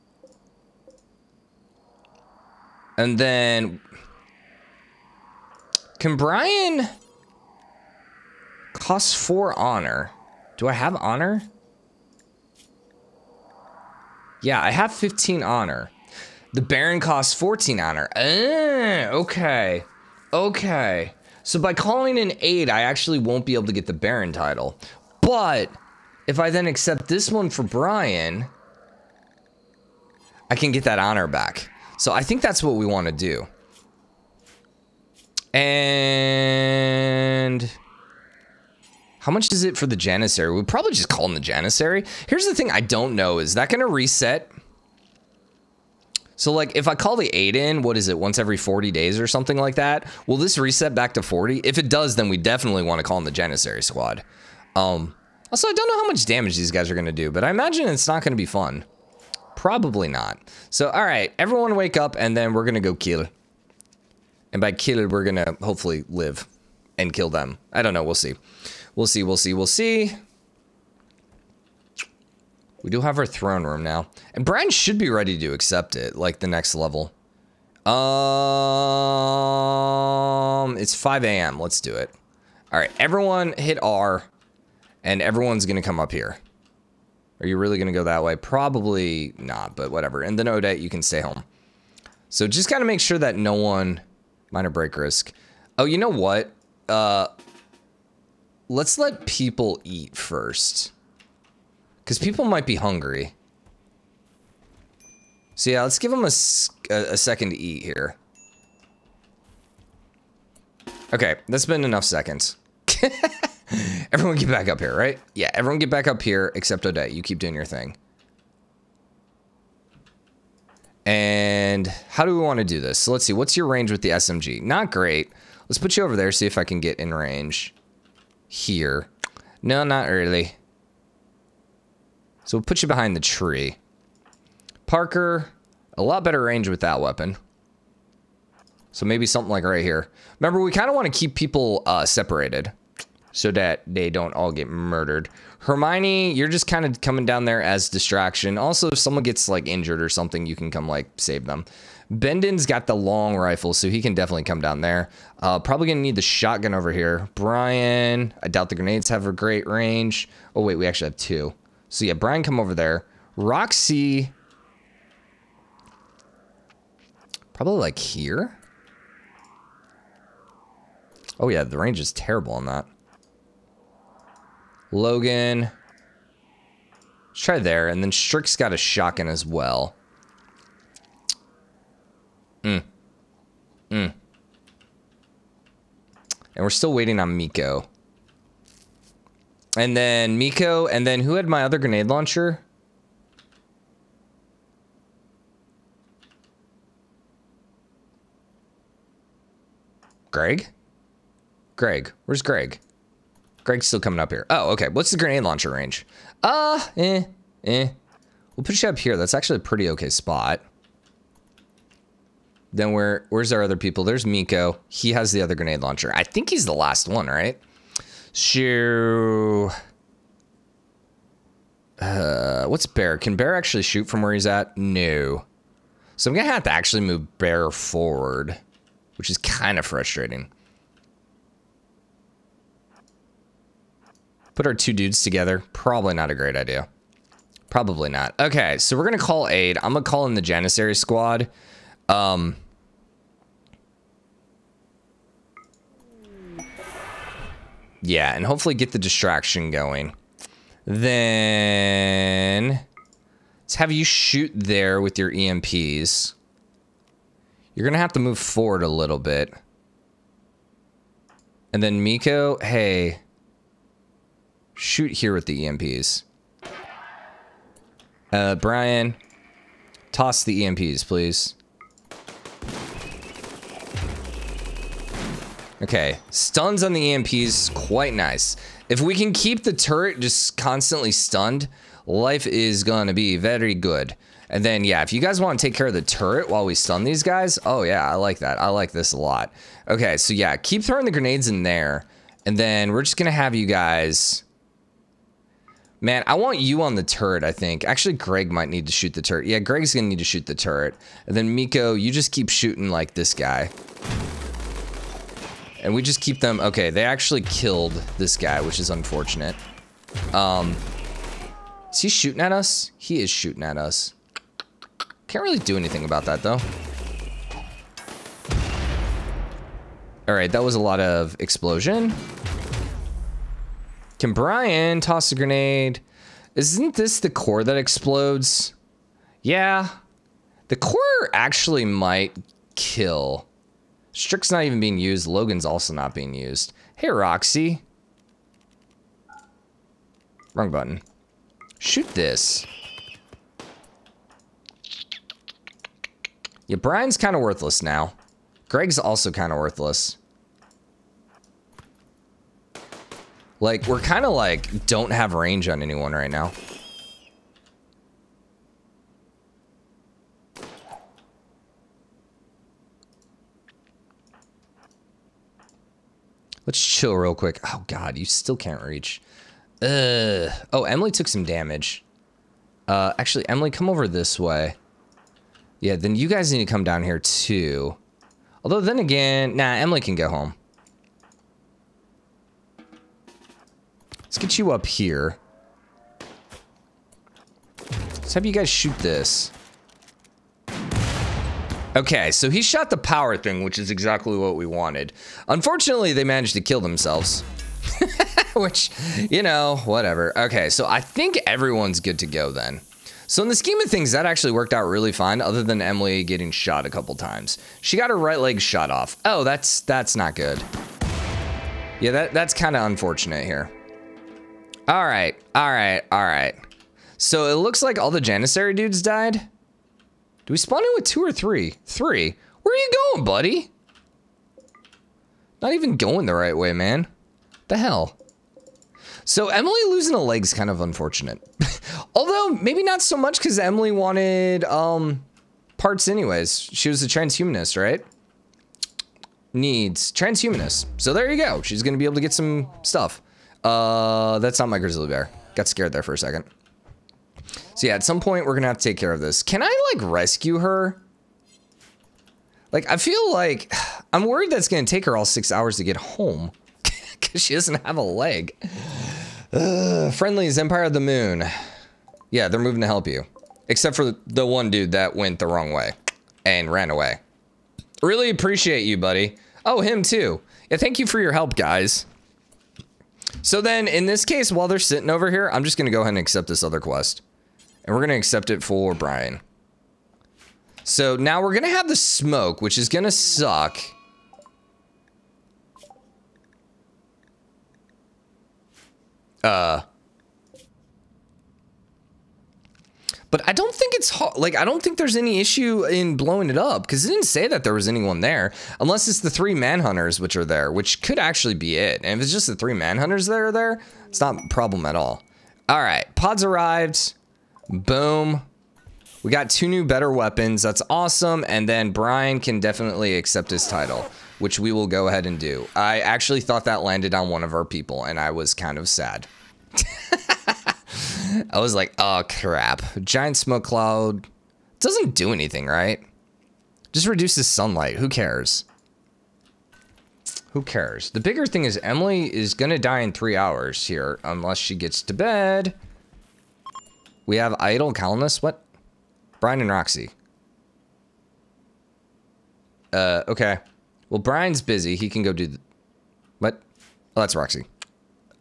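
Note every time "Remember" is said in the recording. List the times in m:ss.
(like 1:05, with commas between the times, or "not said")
2:20.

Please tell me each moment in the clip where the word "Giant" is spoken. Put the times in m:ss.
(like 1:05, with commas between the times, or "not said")
8:43.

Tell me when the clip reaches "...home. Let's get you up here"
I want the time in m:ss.
6:20.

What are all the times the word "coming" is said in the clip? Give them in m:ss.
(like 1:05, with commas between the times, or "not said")
2:26, 3:23.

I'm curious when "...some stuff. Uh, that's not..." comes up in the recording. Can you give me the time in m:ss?
7:22.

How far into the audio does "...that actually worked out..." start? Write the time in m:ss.
6:44.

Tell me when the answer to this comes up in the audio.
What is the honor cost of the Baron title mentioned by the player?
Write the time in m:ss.
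0:17.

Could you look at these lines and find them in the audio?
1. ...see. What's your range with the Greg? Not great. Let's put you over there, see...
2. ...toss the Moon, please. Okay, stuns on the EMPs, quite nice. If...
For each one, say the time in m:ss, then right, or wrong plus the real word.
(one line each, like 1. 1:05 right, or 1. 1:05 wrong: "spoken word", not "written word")
1. 2:03 wrong: "SMG", not "Greg"
2. 4:30 wrong: "EMPs", not "Moon".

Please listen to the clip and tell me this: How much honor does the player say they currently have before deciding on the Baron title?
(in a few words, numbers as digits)
15.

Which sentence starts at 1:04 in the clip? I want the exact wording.
And by kill, we're going to hopefully live and kill them.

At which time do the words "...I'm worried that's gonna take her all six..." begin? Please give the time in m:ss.
7:34.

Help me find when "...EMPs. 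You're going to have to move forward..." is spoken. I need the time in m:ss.
4:15.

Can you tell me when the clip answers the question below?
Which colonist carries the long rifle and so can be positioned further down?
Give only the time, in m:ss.
2:32.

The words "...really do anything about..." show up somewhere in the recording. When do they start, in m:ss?
5:15.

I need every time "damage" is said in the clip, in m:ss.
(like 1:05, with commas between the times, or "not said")
0:56, 6:11.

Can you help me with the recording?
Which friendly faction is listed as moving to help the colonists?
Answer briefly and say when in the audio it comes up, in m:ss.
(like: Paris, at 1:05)
Empire of the Moon, at 7:40.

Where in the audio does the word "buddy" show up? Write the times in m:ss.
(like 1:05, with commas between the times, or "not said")
7:03, 7:48.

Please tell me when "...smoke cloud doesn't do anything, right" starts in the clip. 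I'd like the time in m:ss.
8:43.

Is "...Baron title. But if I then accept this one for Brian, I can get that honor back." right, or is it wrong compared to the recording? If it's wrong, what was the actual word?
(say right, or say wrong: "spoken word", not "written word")
right.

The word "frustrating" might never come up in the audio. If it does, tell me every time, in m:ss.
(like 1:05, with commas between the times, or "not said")
3:49.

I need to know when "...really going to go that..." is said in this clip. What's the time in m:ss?
1:27.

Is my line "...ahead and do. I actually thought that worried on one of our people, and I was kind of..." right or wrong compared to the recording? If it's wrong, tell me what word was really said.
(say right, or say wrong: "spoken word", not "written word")
wrong: "landed", not "worried".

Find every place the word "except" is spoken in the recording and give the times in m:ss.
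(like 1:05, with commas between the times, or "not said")
1:56, 7:43.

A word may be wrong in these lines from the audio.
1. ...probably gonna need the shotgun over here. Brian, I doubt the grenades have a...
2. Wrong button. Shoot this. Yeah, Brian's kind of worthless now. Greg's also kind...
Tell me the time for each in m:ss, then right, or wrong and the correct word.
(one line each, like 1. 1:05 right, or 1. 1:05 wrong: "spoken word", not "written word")
1. 2:35 right
2. 5:40 right.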